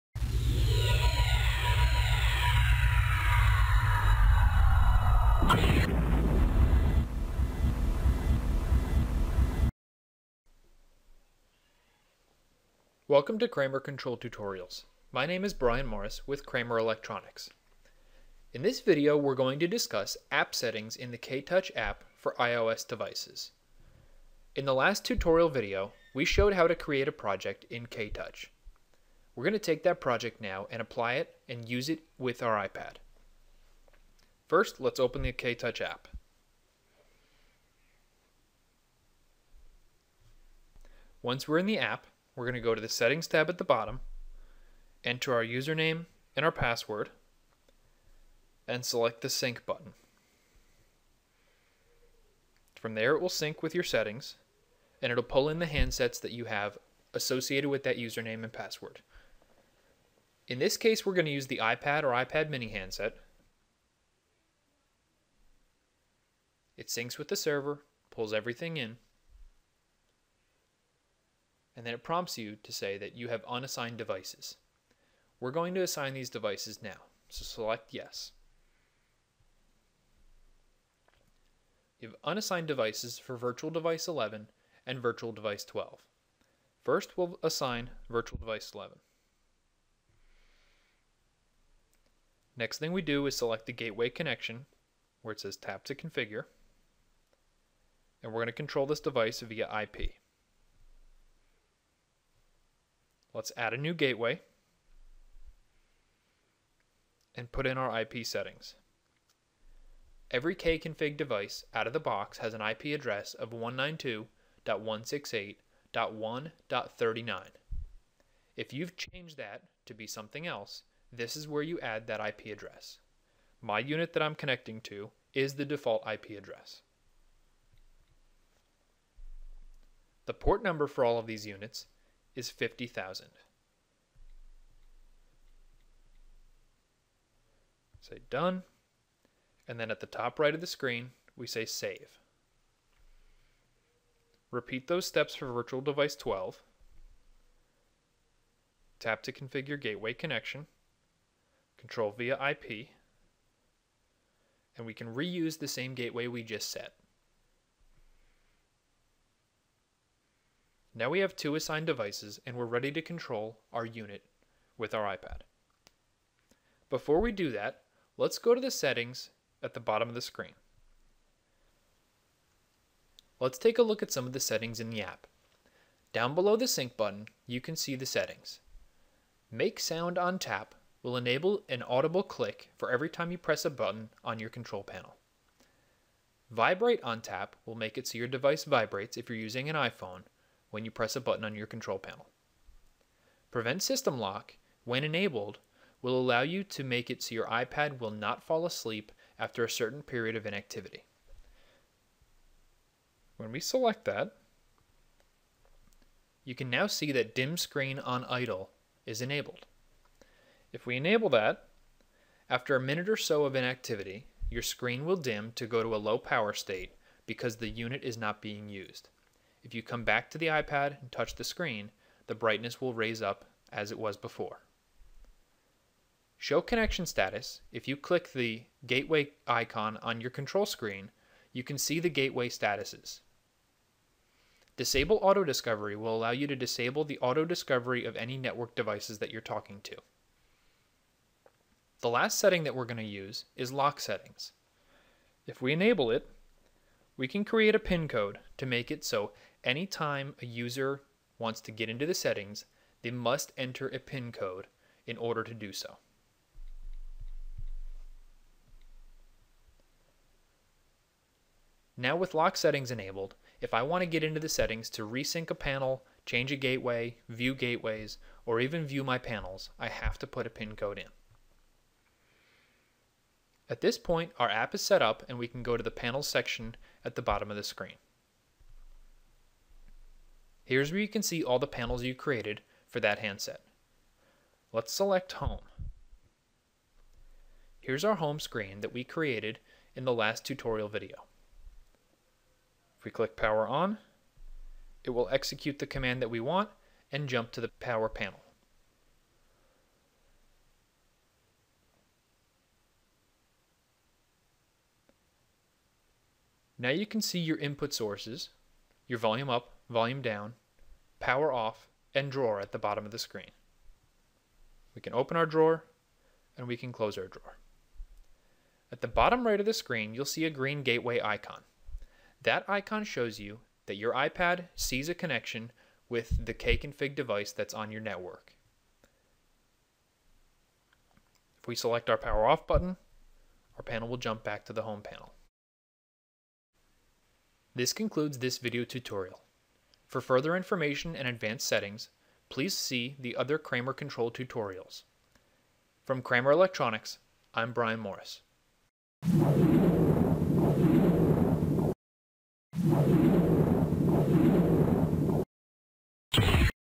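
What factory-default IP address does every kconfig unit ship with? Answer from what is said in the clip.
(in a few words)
192.168.1.39.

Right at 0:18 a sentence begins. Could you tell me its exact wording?
In this video, we're going to discuss app settings in the K-Touch app for iOS devices.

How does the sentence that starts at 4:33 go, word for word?
At this point, our app is set up and we can go to the panel section at the bottom of the screen.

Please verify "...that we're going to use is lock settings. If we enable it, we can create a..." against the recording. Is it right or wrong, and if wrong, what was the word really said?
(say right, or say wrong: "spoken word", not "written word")
right.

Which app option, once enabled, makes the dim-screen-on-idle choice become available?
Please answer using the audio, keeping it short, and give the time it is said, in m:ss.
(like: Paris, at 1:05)
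Prevent System Lock, at 3:13.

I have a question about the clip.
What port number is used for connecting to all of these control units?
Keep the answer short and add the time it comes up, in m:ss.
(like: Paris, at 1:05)
50,000, at 2:12.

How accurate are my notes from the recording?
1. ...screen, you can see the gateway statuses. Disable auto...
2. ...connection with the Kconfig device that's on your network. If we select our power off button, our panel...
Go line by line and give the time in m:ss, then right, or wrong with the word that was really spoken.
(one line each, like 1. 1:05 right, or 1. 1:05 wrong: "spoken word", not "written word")
1. 3:50 right
2. 5:25 right.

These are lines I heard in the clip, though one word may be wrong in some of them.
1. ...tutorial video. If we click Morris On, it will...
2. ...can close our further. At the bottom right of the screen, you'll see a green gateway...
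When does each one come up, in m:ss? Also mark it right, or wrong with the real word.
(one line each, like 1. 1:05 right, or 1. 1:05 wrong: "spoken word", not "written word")
1. 4:50 wrong: "Power", not "Morris"
2. 5:16 wrong: "drawer", not "further".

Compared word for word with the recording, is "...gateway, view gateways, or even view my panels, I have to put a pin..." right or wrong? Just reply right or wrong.
right.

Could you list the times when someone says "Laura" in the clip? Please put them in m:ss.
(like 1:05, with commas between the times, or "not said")
not said.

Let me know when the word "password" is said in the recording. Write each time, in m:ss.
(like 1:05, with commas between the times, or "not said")
0:46, 0:58.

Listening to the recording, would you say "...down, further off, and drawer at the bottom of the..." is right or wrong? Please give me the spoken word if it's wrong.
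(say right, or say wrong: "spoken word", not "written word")
wrong: "power", not "further".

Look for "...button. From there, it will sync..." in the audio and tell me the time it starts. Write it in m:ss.
0:49.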